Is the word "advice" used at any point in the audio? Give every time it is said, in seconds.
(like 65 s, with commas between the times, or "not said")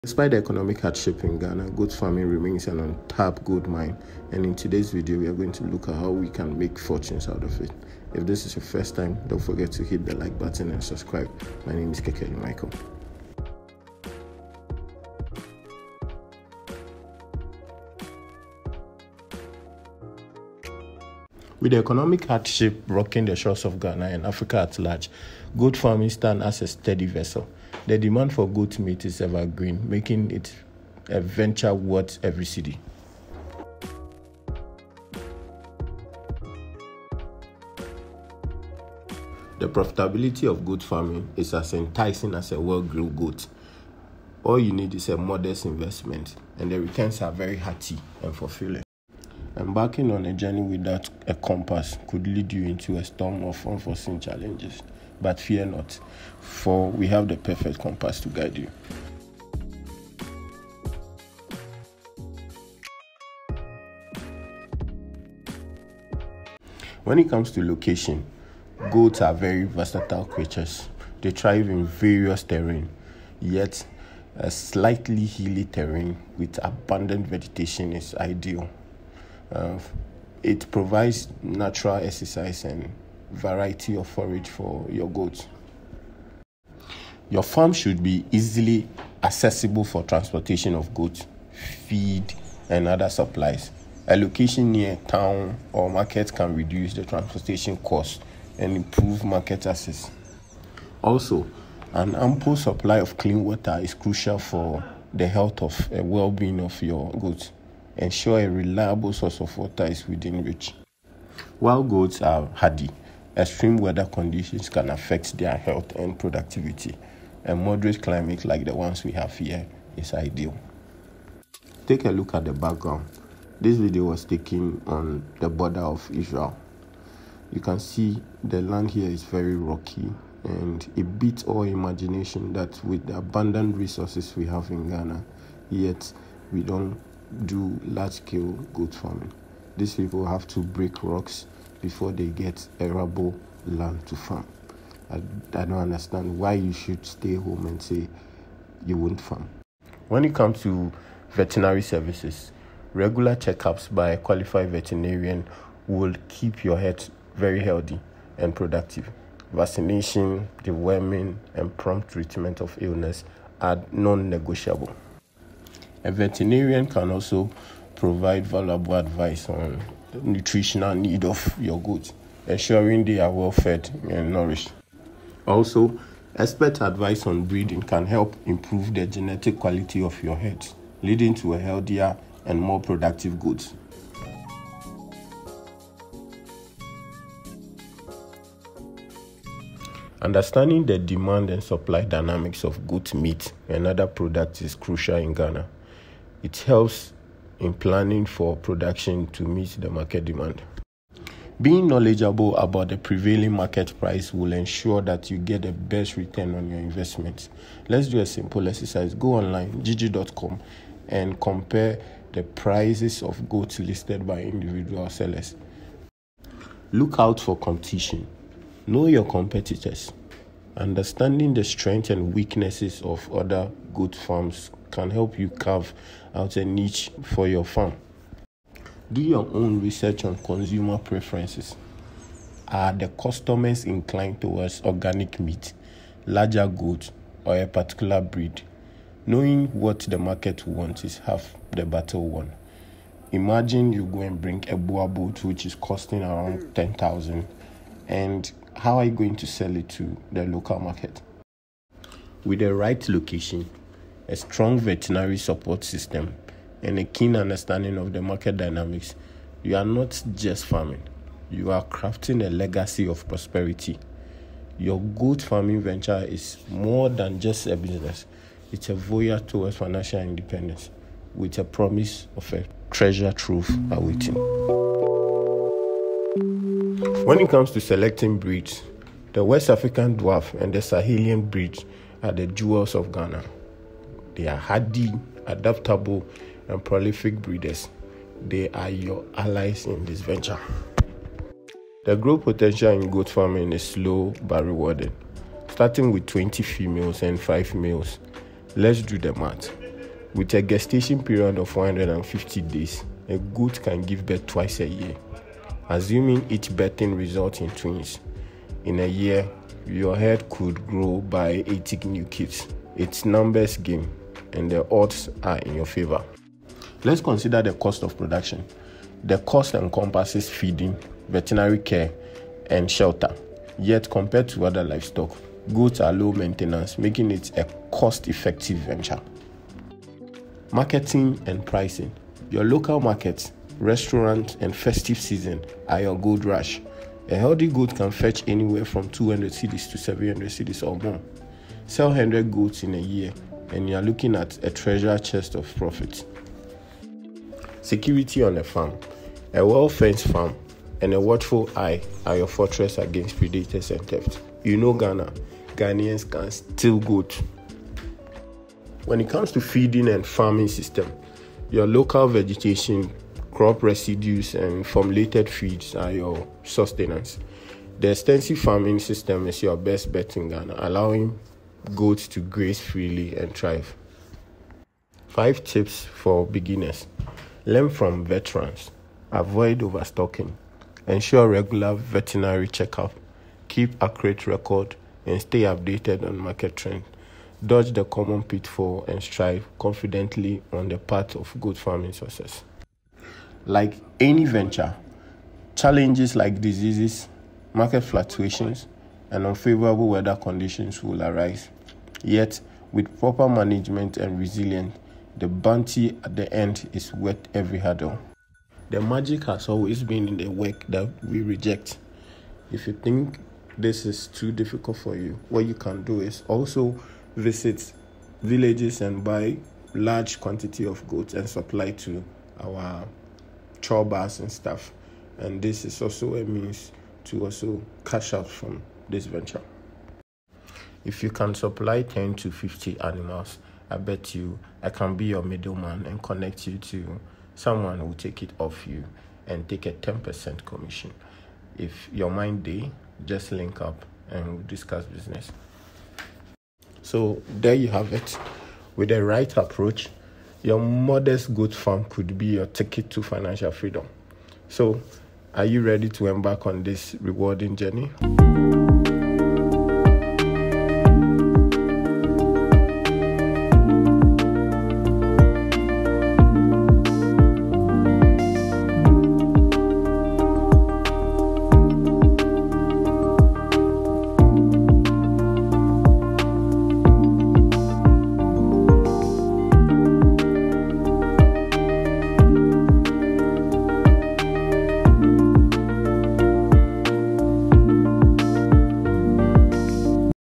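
168 s, 176 s.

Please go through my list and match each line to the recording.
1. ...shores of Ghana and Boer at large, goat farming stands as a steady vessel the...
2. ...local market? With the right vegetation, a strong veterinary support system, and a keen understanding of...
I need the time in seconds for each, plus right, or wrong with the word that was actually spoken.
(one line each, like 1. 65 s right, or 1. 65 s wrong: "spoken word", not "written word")
1. 23 s wrong: "Africa", not "Boer"
2. 250 s wrong: "location", not "vegetation".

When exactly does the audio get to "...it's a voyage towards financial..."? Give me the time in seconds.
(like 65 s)
268 s.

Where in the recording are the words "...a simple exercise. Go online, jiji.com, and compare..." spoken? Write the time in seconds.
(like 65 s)
208 s.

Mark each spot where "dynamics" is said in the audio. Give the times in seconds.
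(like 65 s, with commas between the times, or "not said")
192 s, 258 s.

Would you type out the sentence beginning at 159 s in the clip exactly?
Vaccination, deworming, and prompt treatment of illness are non negotiable.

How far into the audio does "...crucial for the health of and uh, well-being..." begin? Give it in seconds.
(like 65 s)
103 s.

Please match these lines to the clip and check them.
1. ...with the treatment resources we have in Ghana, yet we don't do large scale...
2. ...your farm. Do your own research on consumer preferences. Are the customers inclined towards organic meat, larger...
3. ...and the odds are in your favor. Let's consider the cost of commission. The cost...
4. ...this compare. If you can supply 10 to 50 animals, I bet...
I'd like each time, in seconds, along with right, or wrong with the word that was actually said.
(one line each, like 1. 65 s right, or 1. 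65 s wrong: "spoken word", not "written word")
1. 132 s wrong: "abundant", not "treatment"
2. 227 s right
3. 314 s wrong: "production", not "commission"
4. 429 s wrong: "venture", not "compare".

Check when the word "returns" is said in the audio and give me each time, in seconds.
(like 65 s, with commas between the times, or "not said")
46 s, 206 s.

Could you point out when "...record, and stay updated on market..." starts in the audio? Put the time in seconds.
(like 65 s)
384 s.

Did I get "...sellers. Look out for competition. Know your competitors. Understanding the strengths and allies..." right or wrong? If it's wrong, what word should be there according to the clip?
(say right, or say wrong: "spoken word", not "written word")
wrong: "weaknesses", not "allies".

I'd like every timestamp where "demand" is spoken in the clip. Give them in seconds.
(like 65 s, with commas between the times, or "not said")
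27 s, 190 s, 200 s.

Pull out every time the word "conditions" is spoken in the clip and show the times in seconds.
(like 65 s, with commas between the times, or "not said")
114 s, 400 s.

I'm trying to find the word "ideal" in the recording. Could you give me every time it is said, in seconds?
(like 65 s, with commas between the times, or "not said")
78 s, 120 s.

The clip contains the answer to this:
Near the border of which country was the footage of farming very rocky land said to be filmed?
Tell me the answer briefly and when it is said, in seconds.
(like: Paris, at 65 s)
Israel, at 126 s.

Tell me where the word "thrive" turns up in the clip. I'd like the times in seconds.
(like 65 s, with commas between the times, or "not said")
71 s, 373 s.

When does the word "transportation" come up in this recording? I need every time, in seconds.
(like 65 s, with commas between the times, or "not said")
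90 s, 97 s.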